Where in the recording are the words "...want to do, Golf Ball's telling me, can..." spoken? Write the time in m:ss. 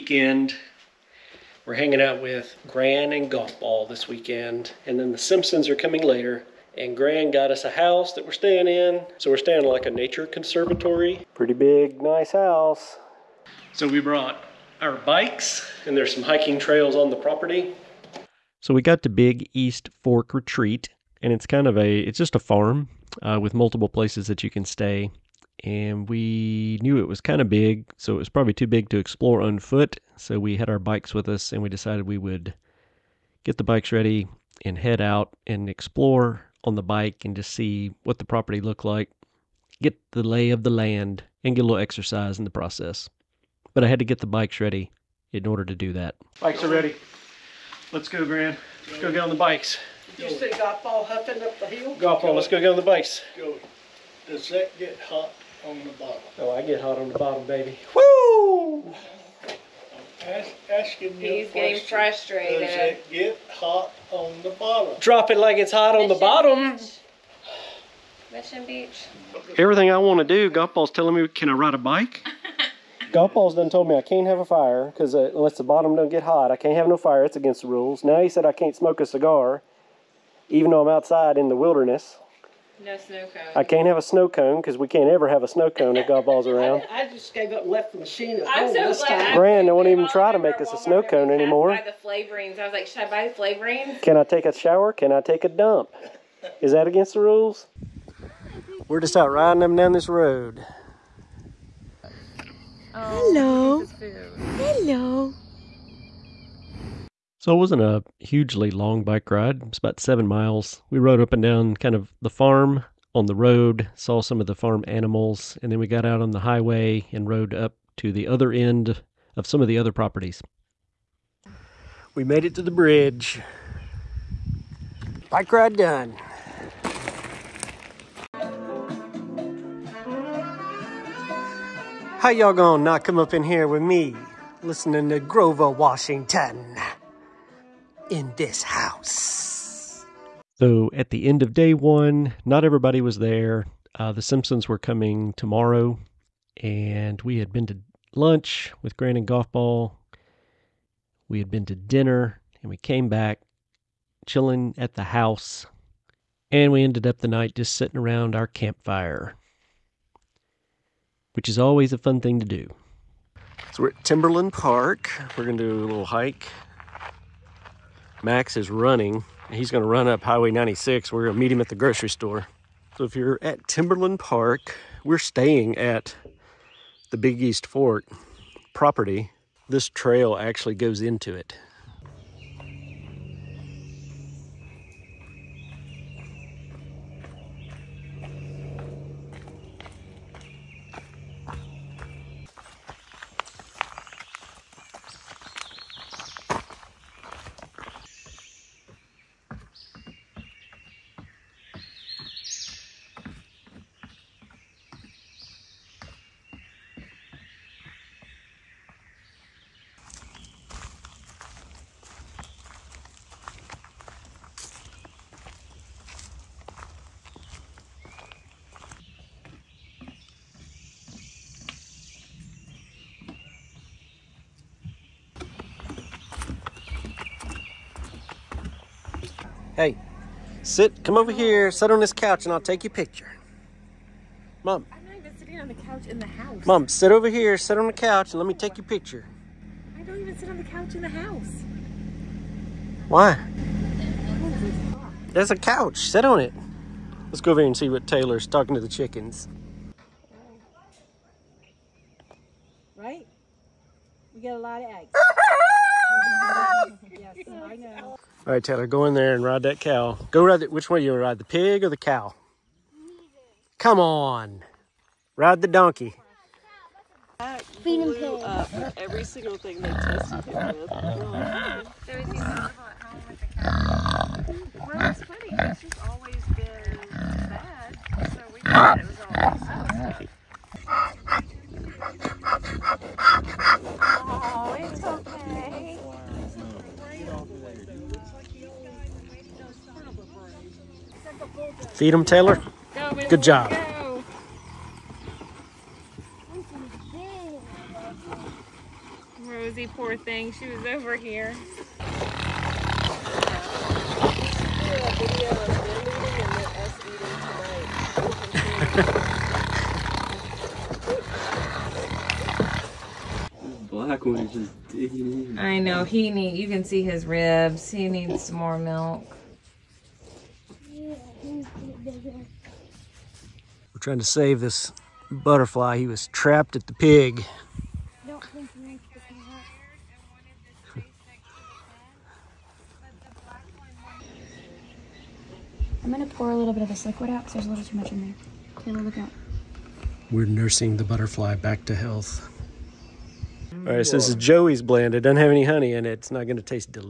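1:09.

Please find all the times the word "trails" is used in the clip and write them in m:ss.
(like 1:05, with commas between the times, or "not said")
0:16, 2:59.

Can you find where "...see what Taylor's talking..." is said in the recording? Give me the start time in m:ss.
4:07.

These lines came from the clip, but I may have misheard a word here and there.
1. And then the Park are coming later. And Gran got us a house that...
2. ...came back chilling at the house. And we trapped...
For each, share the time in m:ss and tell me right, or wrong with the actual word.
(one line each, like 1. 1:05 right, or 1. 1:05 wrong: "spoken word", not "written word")
1. 0:04 wrong: "Simpsons", not "Park"
2. 2:32 wrong: "ended", not "trapped".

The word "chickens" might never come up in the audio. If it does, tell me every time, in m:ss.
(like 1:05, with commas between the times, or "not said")
4:08.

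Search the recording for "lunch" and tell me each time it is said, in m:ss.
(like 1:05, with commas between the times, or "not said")
2:28.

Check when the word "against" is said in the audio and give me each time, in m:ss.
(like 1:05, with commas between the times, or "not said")
1:17, 1:36.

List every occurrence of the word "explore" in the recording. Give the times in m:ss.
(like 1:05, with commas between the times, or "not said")
0:28, 0:35.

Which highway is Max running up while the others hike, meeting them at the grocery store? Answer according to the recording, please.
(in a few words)
Highway 96.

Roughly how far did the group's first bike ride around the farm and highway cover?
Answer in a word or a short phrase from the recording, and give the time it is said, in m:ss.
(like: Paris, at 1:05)
7 miles, at 1:49.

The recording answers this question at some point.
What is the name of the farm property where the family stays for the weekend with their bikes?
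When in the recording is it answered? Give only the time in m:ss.
0:19.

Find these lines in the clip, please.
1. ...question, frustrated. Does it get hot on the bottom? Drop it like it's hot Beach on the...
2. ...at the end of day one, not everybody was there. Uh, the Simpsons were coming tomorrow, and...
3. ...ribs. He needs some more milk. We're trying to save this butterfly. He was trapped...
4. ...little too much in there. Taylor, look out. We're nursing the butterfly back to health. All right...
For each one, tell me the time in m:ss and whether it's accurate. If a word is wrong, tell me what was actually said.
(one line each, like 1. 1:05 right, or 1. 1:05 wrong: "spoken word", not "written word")
1. 1:01 wrong: "Mission", not "Beach"
2. 2:20 right
3. 5:17 right
4. 5:37 right.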